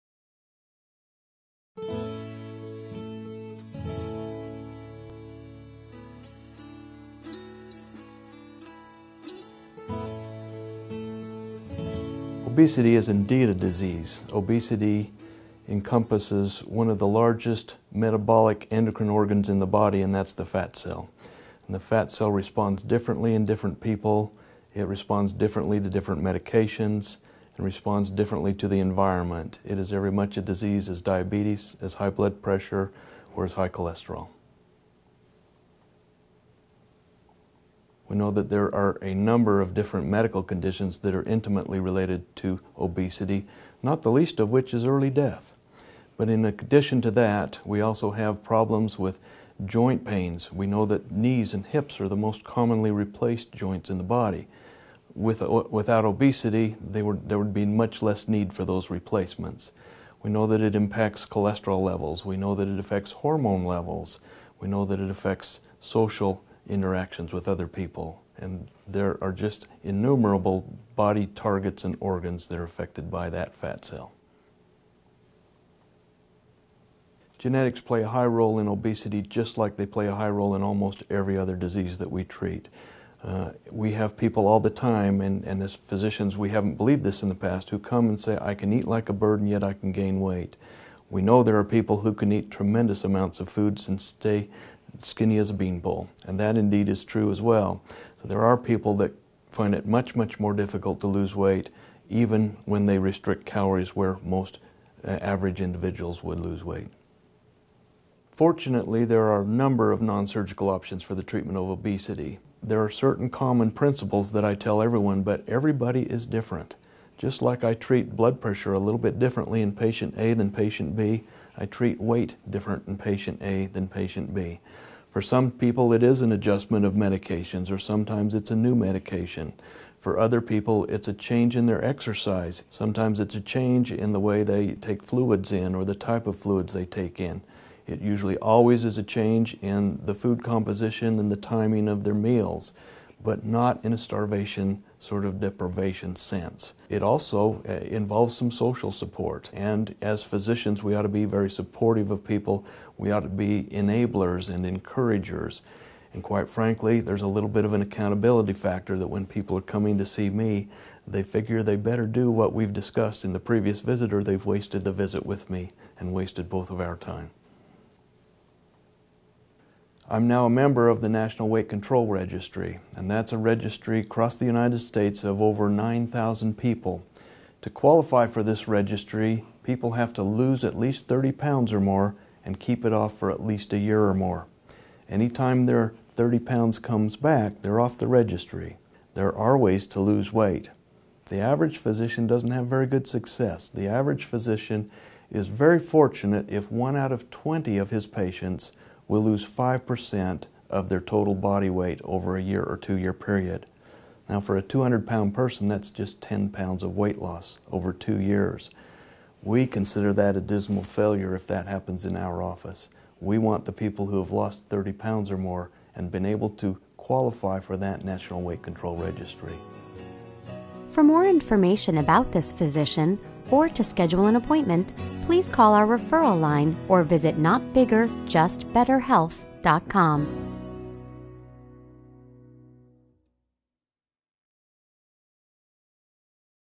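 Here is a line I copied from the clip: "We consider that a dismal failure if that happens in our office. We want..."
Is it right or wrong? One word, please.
right.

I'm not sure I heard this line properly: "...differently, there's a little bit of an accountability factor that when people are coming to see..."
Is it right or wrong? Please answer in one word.
wrong.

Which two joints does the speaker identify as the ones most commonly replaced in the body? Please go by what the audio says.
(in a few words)
knees and hips.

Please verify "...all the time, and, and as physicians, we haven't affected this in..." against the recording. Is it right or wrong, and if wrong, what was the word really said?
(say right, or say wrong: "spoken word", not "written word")
wrong: "believed", not "affected".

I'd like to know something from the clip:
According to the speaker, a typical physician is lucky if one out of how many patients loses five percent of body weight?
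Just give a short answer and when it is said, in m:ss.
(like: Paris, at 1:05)
20, at 3:17.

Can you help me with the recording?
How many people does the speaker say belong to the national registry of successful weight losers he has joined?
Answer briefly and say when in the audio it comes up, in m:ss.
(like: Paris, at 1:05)
over 9,000, at 2:55.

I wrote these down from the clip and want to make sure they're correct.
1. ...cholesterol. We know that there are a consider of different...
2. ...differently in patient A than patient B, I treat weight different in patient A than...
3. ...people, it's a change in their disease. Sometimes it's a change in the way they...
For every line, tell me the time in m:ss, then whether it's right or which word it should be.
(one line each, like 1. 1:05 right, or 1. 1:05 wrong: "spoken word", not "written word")
1. 0:33 wrong: "number", not "consider"
2. 1:59 right
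3. 2:10 wrong: "exercise", not "disease".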